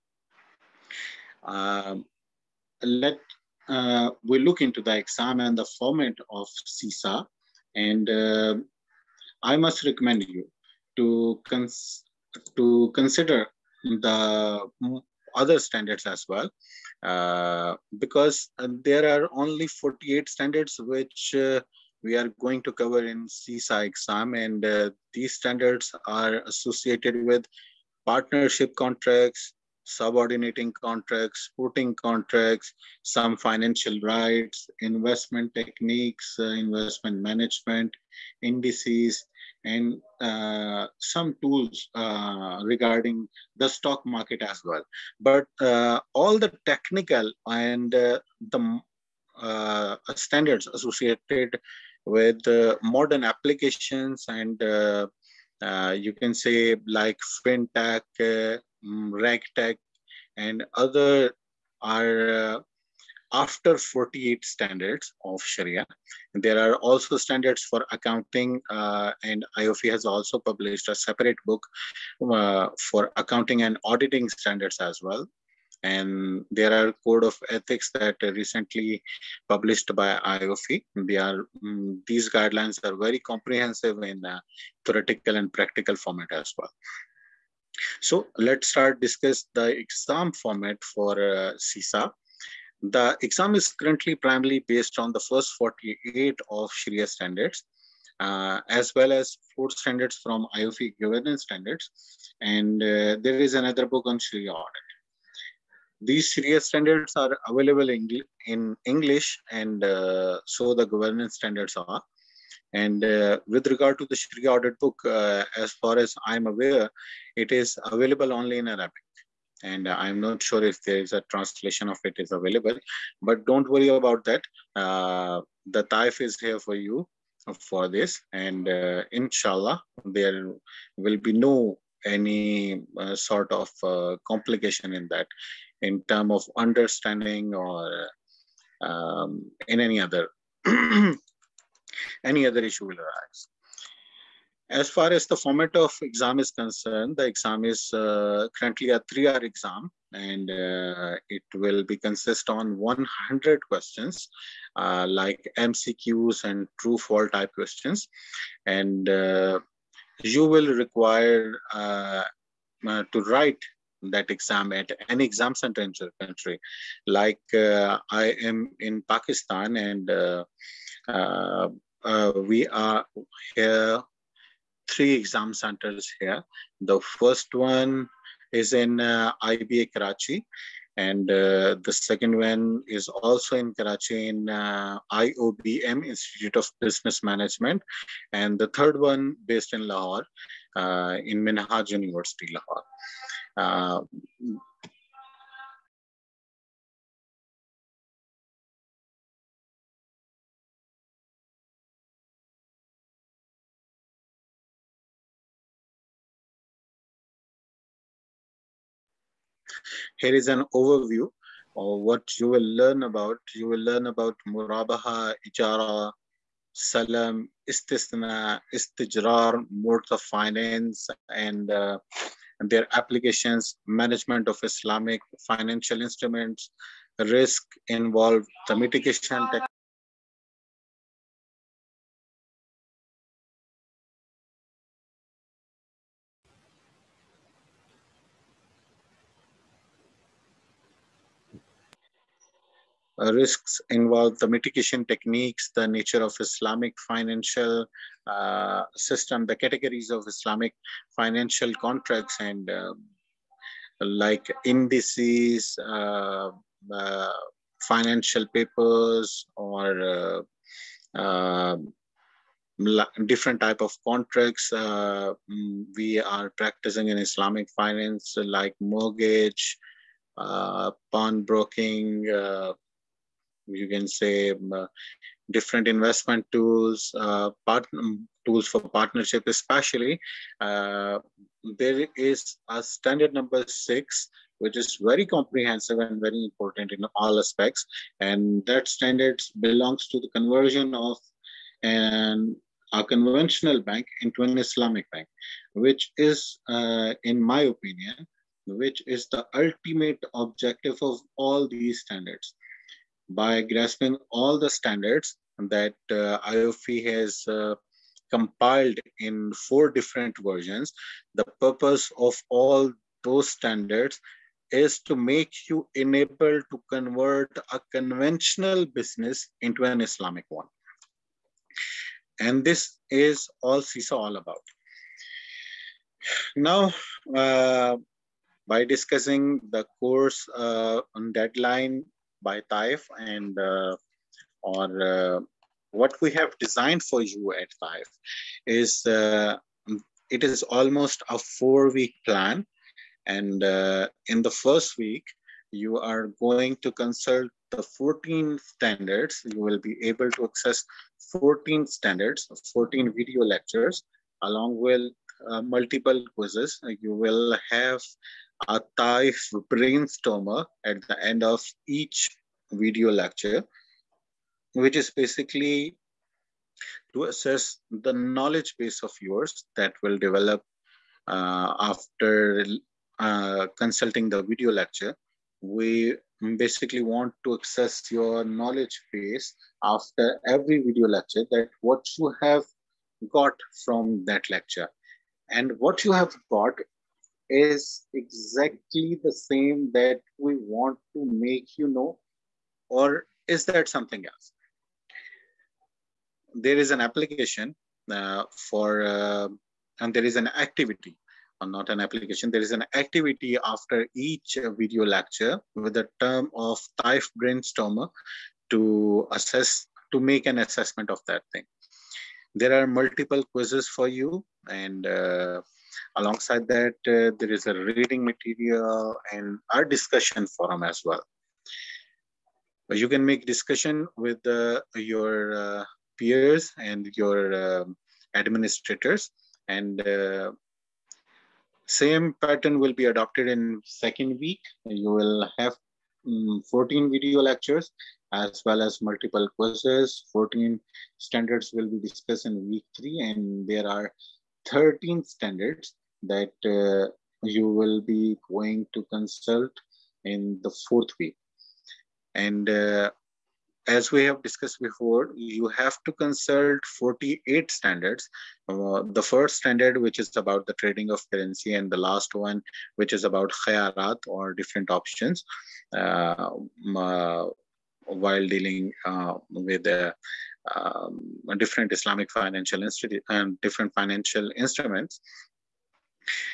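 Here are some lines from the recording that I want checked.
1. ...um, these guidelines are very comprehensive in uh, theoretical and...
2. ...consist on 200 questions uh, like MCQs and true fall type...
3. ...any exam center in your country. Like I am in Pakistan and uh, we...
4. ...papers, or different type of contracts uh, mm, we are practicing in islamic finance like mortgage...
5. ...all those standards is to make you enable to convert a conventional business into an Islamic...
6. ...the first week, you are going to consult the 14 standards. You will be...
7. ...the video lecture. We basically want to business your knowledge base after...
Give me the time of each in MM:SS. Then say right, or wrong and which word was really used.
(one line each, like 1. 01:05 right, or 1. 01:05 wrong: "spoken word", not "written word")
1. 01:21 right
2. 02:31 wrong: "100", not "200"
3. 02:45 right
4. 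04:18 right
5. 05:12 right
6. 05:44 right
7. 06:14 wrong: "access", not "business".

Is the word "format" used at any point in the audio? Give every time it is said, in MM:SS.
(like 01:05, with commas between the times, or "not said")
00:05, 01:25, 01:30, 02:25.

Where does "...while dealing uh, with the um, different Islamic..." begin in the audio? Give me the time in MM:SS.
07:48.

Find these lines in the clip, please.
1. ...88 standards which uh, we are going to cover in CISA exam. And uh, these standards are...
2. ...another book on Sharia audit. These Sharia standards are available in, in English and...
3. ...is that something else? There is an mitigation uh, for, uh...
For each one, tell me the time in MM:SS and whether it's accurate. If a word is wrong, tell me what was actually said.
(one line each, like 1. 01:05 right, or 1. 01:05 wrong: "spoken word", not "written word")
1. 00:19 wrong: "48", not "88"
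2. 01:43 right
3. 06:33 wrong: "application", not "mitigation".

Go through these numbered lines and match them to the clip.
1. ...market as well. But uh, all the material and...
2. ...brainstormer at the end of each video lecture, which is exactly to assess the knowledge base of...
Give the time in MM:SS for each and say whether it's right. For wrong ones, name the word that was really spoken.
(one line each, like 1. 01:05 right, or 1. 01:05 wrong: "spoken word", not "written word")
1. 00:44 wrong: "technical", not "material"
2. 05:59 wrong: "basically", not "exactly".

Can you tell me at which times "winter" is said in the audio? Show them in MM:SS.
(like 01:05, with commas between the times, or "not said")
not said.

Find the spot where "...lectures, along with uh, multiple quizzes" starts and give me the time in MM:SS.
05:53.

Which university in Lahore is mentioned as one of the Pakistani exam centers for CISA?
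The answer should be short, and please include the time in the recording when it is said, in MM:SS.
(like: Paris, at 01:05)
Minhaj University, at 03:11.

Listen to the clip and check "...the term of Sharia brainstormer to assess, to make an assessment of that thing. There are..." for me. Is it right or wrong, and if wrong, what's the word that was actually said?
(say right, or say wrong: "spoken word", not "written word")
wrong: "Taif", not "Sharia".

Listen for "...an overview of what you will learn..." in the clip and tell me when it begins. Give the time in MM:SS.
03:30.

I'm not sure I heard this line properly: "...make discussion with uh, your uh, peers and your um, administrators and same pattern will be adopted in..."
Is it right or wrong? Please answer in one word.
right.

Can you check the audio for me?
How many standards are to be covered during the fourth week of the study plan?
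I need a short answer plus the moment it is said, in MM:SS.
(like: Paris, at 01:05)
13, at 07:24.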